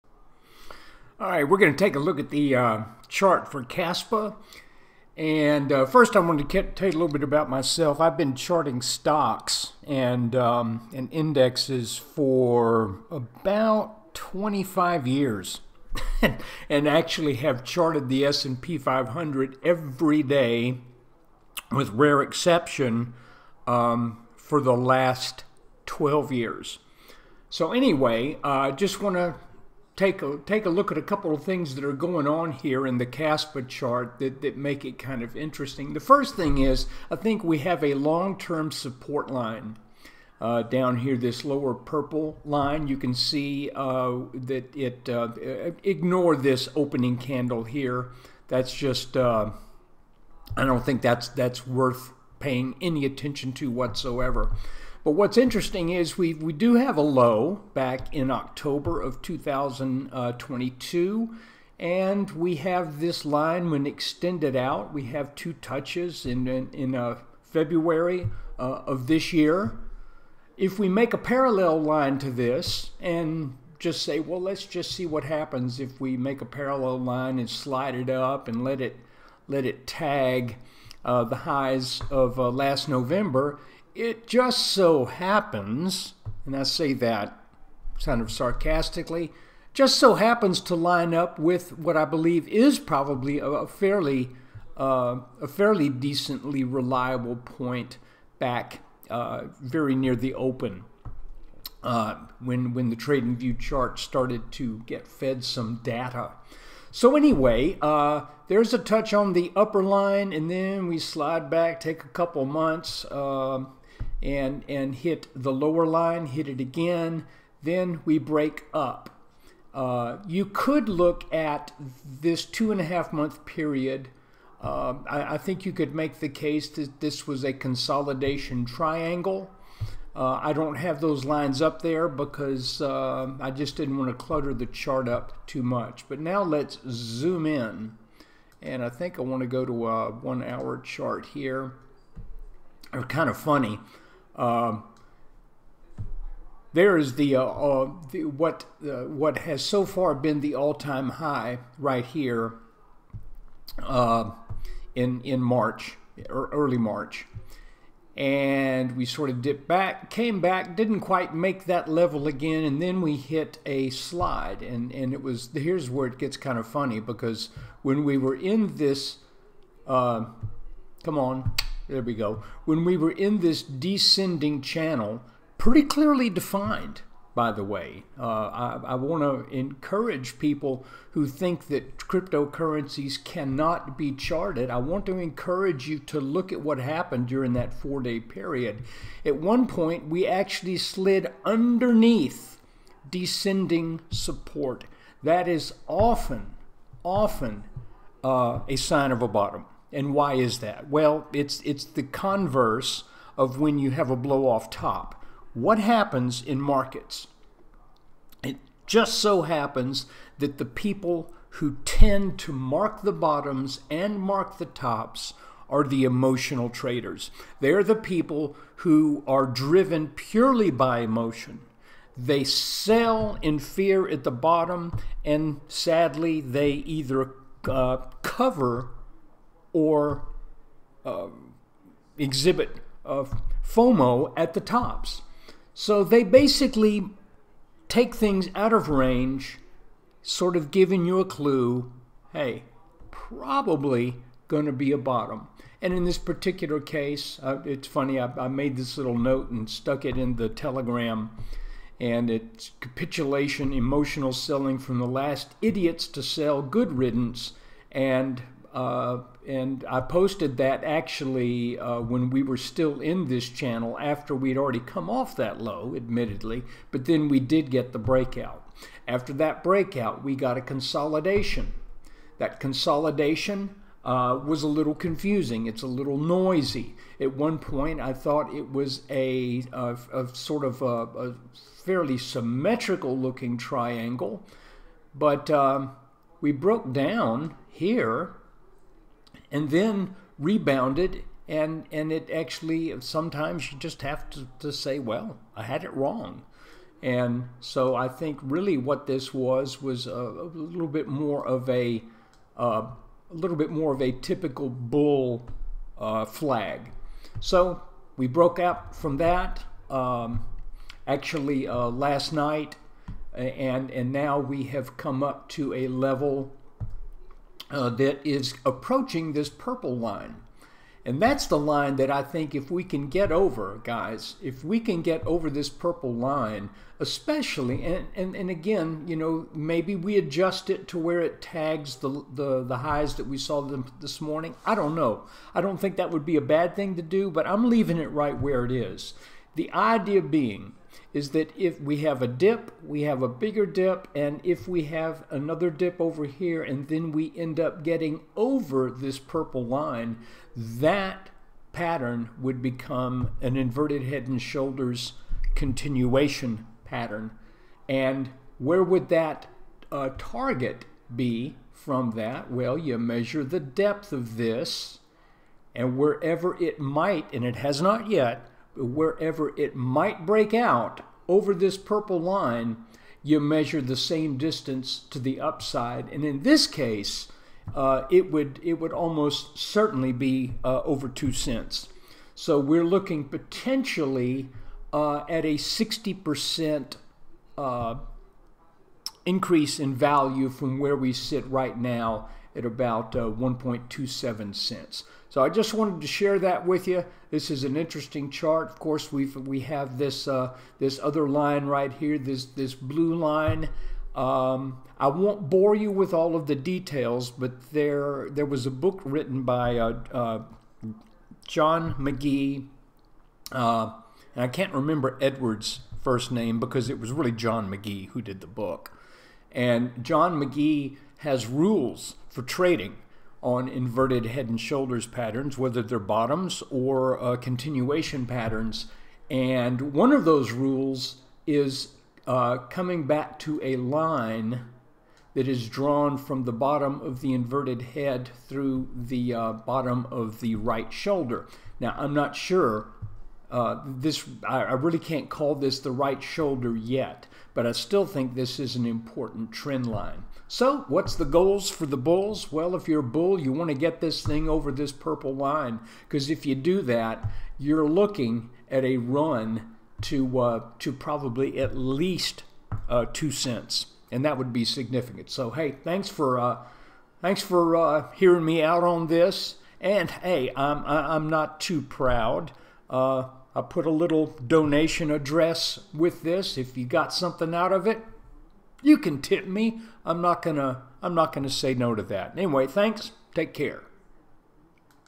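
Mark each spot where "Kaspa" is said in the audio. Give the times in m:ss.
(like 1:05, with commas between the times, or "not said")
0:03, 0:33.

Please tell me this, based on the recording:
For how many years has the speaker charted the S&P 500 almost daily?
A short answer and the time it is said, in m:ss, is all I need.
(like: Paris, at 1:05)
12 years, at 0:24.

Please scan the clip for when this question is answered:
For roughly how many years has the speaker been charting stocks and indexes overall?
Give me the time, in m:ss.
0:13.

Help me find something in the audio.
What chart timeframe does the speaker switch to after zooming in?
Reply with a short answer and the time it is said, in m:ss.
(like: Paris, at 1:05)
one hour, at 2:20.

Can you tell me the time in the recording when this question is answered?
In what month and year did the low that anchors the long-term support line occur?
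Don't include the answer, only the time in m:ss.
0:58.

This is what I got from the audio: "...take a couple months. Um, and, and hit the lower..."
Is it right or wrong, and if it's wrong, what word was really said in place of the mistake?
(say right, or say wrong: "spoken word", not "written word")
right.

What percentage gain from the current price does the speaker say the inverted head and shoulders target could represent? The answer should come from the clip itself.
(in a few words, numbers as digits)
60%.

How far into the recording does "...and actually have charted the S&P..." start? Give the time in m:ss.
0:16.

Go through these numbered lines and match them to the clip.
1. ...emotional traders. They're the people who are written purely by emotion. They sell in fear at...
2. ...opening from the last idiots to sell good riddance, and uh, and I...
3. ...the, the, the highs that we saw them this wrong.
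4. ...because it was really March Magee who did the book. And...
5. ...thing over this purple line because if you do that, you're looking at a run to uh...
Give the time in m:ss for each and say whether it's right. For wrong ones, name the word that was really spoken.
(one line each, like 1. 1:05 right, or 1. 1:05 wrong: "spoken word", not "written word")
1. 3:36 wrong: "driven", not "written"
2. 4:14 wrong: "selling", not "opening"
3. 5:31 wrong: "morning", not "wrong"
4. 6:56 wrong: "John", not "March"
5. 7:34 right.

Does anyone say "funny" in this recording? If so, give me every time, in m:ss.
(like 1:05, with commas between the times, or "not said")
2:23, 2:46, 4:07.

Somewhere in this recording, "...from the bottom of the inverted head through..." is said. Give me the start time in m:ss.
7:16.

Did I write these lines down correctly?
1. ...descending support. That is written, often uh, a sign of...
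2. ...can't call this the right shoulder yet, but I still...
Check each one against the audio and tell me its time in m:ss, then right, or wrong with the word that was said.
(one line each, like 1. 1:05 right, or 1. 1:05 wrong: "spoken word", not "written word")
1. 3:13 wrong: "often", not "written"
2. 7:24 right.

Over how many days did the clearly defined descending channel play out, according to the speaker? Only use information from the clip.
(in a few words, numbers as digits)
4 days.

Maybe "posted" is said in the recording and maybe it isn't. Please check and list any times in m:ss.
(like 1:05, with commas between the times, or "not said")
4:19.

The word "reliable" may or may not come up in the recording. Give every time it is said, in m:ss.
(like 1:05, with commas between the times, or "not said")
1:36.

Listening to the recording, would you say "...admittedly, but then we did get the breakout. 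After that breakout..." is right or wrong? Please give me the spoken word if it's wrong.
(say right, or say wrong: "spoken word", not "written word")
right.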